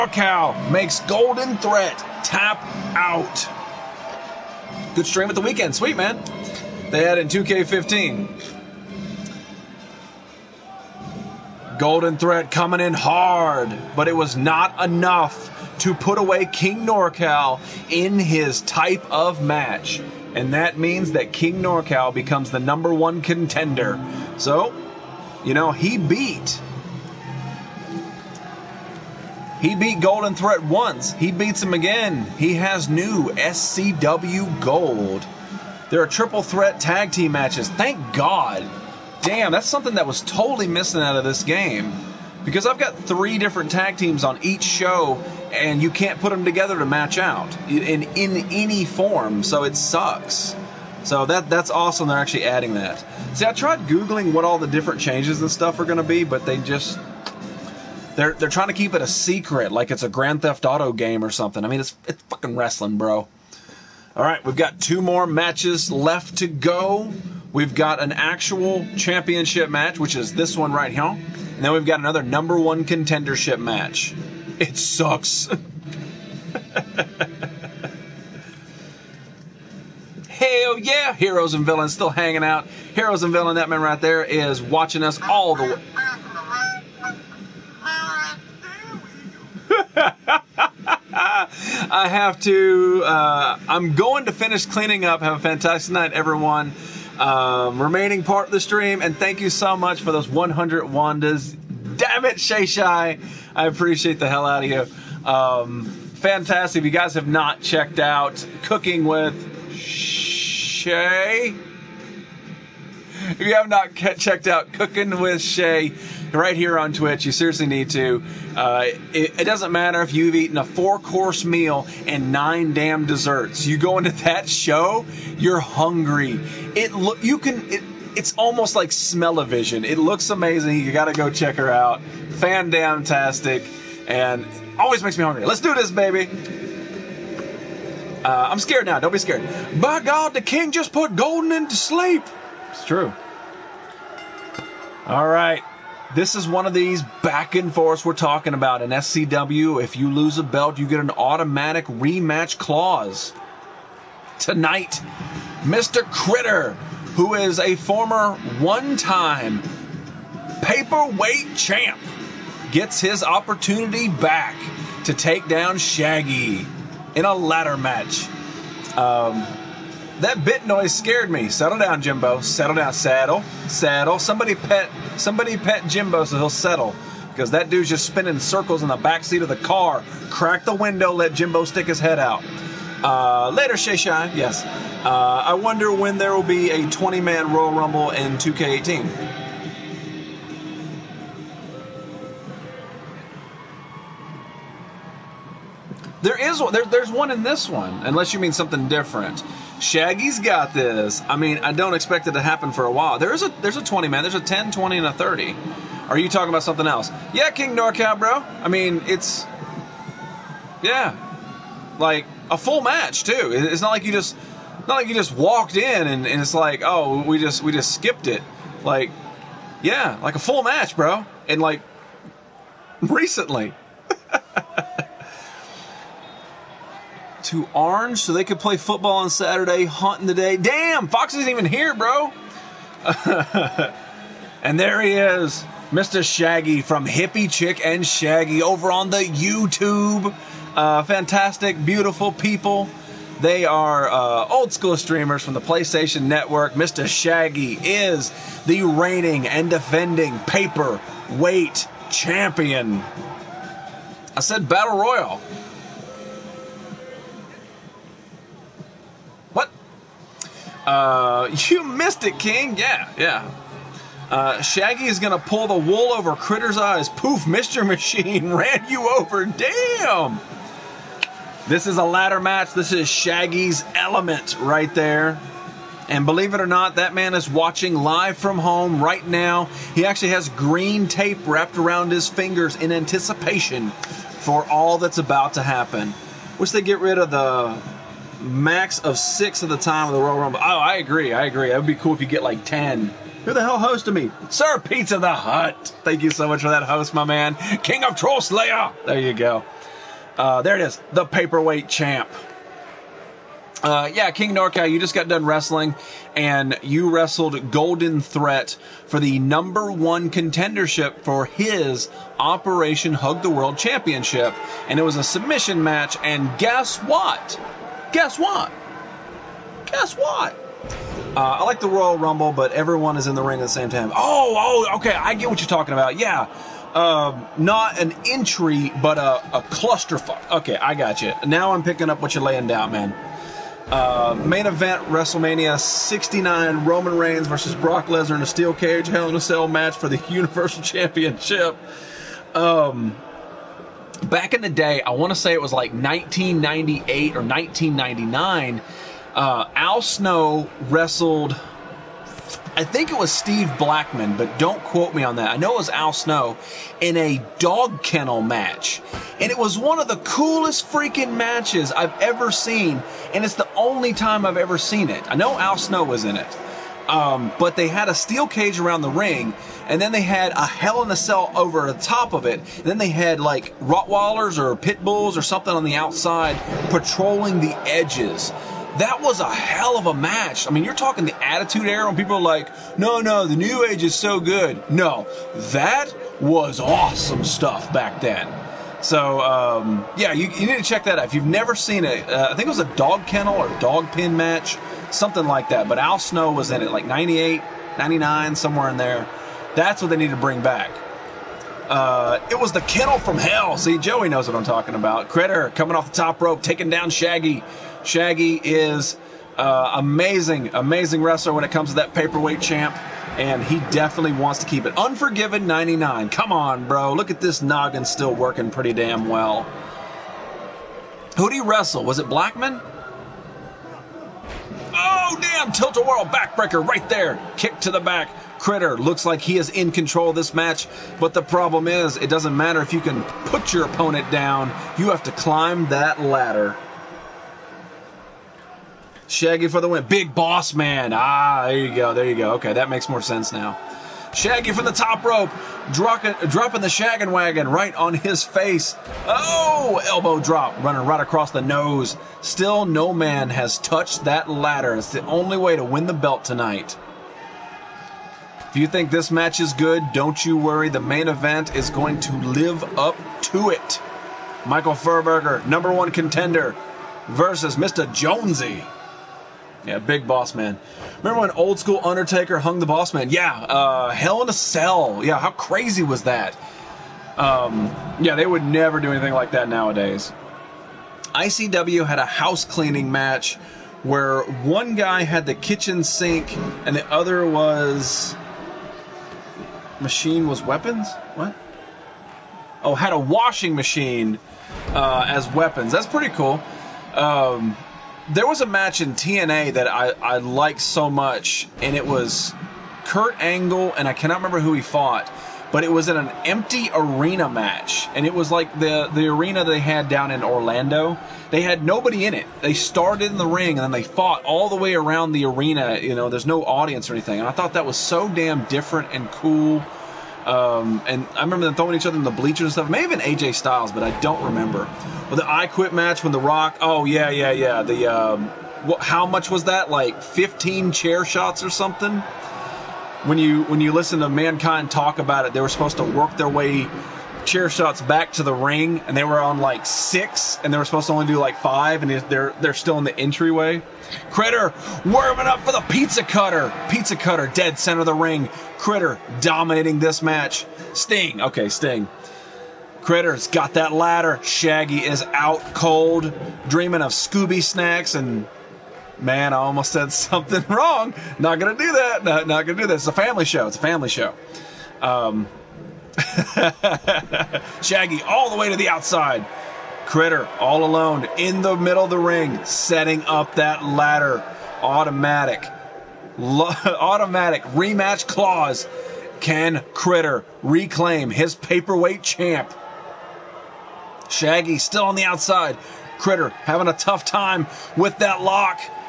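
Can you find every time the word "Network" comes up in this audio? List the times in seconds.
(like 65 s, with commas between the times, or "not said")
246 s.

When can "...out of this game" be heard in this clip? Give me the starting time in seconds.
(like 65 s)
41 s.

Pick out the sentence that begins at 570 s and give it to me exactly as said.
Critter all alone in the middle of the ring, setting up that ladder.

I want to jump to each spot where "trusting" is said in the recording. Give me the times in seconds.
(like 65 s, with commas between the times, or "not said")
not said.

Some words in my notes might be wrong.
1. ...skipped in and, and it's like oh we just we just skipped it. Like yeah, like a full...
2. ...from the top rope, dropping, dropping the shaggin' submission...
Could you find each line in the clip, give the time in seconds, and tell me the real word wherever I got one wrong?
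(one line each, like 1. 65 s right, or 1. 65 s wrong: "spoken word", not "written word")
1. 215 s wrong: "walked", not "skipped"
2. 444 s wrong: "wagon", not "submission".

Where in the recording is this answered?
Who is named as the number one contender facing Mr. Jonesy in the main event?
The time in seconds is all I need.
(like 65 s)
464 s.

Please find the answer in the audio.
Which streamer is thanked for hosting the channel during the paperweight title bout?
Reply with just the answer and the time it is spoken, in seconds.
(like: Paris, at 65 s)
Sir Pizza the Hut, at 294 s.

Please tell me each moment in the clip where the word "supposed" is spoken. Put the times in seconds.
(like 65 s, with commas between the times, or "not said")
535 s, 540 s.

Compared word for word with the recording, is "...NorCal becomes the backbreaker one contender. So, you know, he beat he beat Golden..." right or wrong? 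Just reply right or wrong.
wrong.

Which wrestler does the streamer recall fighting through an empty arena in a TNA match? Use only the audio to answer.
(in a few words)
Kurt Angle.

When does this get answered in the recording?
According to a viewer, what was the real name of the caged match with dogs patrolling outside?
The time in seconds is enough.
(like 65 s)
402 s.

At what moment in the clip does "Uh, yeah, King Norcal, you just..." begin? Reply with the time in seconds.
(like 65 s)
303 s.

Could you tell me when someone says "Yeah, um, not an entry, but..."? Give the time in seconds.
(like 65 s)
326 s.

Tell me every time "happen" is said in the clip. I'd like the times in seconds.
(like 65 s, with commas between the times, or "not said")
202 s, 285 s.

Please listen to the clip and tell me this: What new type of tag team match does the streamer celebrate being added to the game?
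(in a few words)
Triple threat tag team.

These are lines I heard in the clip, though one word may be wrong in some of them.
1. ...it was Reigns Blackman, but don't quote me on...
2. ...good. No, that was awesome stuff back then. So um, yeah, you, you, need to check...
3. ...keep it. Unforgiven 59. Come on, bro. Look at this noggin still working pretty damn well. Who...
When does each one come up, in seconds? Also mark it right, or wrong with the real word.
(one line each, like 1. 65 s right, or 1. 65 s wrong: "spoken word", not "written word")
1. 353 s wrong: "Steve", not "Reigns"
2. 384 s right
3. 414 s wrong: "99", not "59".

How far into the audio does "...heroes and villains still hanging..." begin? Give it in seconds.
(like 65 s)
81 s.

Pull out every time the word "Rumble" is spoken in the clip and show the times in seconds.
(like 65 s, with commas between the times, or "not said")
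187 s, 290 s, 322 s.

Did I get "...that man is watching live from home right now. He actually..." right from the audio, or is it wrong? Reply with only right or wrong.
right.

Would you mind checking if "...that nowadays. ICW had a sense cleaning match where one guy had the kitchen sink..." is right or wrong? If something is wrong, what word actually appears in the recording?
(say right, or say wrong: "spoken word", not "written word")
wrong: "house", not "sense".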